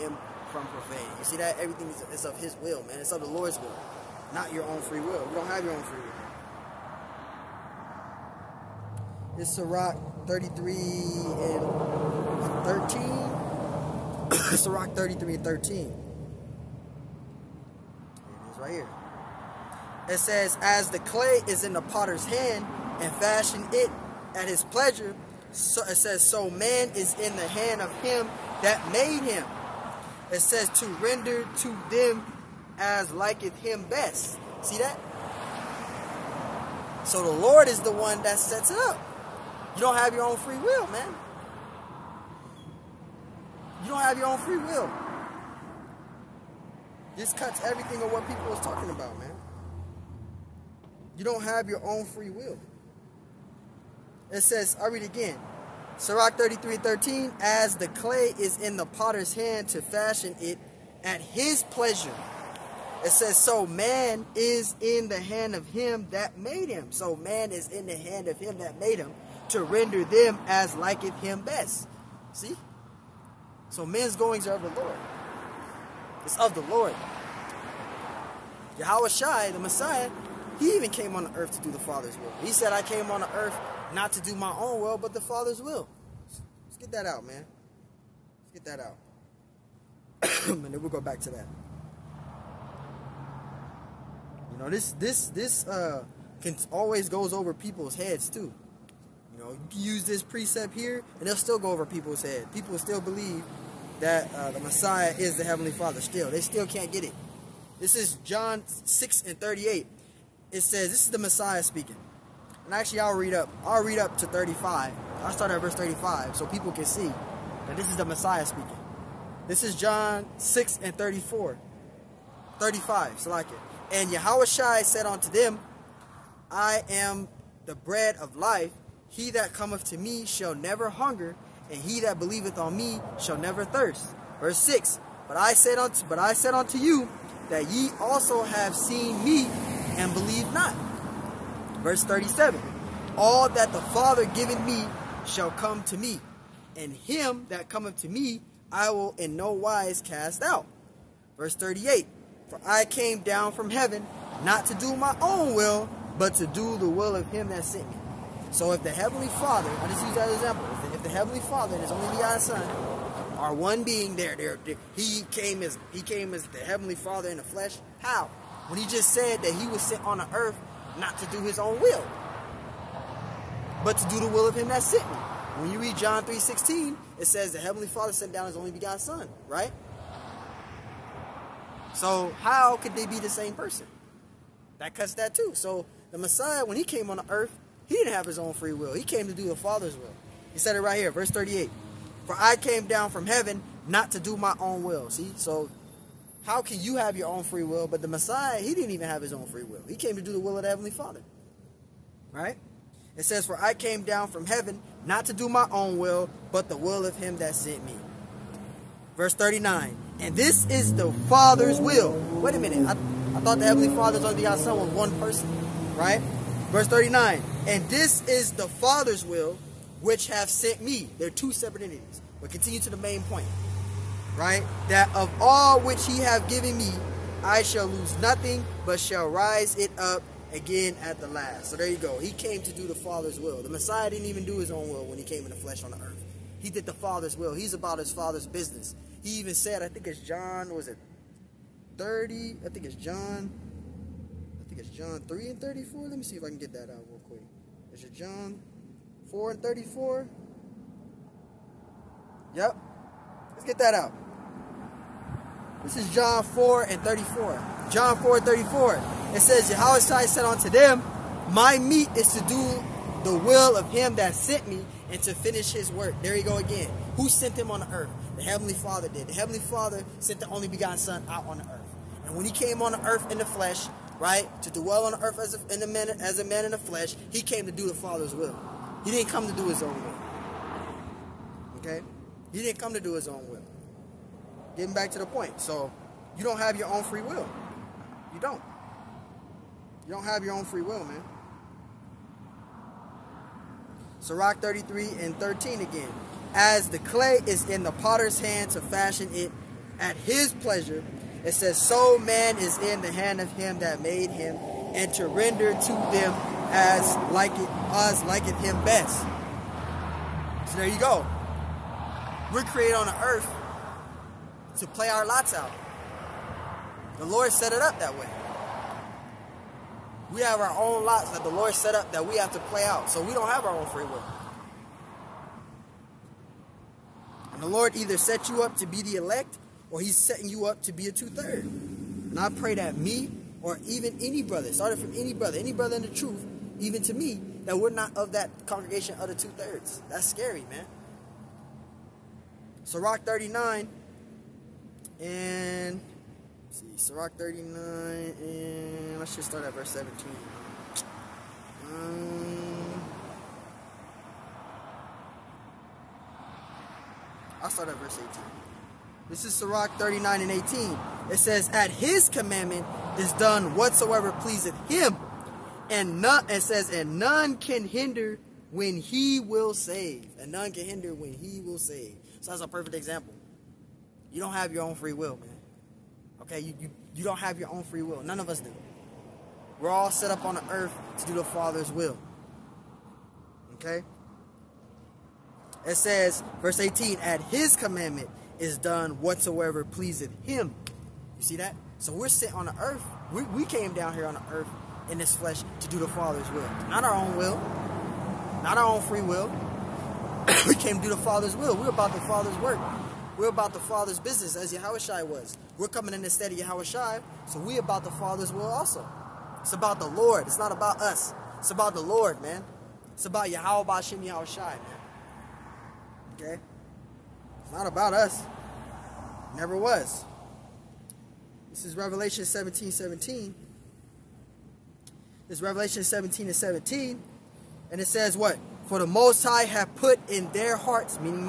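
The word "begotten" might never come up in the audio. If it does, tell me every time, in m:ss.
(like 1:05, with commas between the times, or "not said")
2:42, 2:58, 4:30.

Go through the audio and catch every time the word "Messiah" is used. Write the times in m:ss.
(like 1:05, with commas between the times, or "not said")
1:19, 1:44, 1:51, 1:58, 3:06, 3:18, 3:53.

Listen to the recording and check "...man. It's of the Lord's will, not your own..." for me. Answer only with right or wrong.
right.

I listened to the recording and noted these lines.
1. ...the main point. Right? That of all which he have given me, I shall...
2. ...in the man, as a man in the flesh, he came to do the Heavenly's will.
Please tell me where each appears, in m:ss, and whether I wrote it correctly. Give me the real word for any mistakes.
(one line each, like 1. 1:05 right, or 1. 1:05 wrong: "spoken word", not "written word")
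1. 3:42 right
2. 4:35 wrong: "Father", not "Heavenly".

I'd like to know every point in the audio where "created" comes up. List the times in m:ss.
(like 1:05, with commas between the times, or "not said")
5:12.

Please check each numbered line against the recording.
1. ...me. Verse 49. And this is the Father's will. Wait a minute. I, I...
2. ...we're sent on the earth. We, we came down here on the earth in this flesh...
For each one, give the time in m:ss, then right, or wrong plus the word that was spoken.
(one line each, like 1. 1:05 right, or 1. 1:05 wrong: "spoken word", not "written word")
1. 3:27 wrong: "39", not "49"
2. 6:32 right.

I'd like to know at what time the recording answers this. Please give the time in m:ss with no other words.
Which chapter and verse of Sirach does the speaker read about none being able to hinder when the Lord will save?
5:59.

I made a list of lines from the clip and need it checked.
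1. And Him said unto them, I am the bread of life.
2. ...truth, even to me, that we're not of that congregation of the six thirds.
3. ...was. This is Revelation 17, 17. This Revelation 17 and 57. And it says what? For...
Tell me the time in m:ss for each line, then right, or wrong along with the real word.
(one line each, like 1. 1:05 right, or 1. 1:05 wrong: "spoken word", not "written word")
1. 2:03 wrong: "Yahushua", not "Him"
2. 5:36 wrong: "two", not "six"
3. 6:59 wrong: "17", not "57".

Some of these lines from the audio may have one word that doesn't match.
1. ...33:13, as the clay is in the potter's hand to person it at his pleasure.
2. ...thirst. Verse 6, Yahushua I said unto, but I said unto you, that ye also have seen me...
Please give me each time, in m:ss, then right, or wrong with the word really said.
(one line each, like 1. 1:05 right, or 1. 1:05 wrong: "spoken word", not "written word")
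1. 0:56 wrong: "fashion", not "person"
2. 2:13 wrong: "But", not "Yahushua".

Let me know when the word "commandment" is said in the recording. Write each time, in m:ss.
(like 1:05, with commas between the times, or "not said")
6:02, 6:27.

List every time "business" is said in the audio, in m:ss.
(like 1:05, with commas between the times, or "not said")
3:58, 6:44.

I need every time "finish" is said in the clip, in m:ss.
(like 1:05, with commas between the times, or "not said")
4:25.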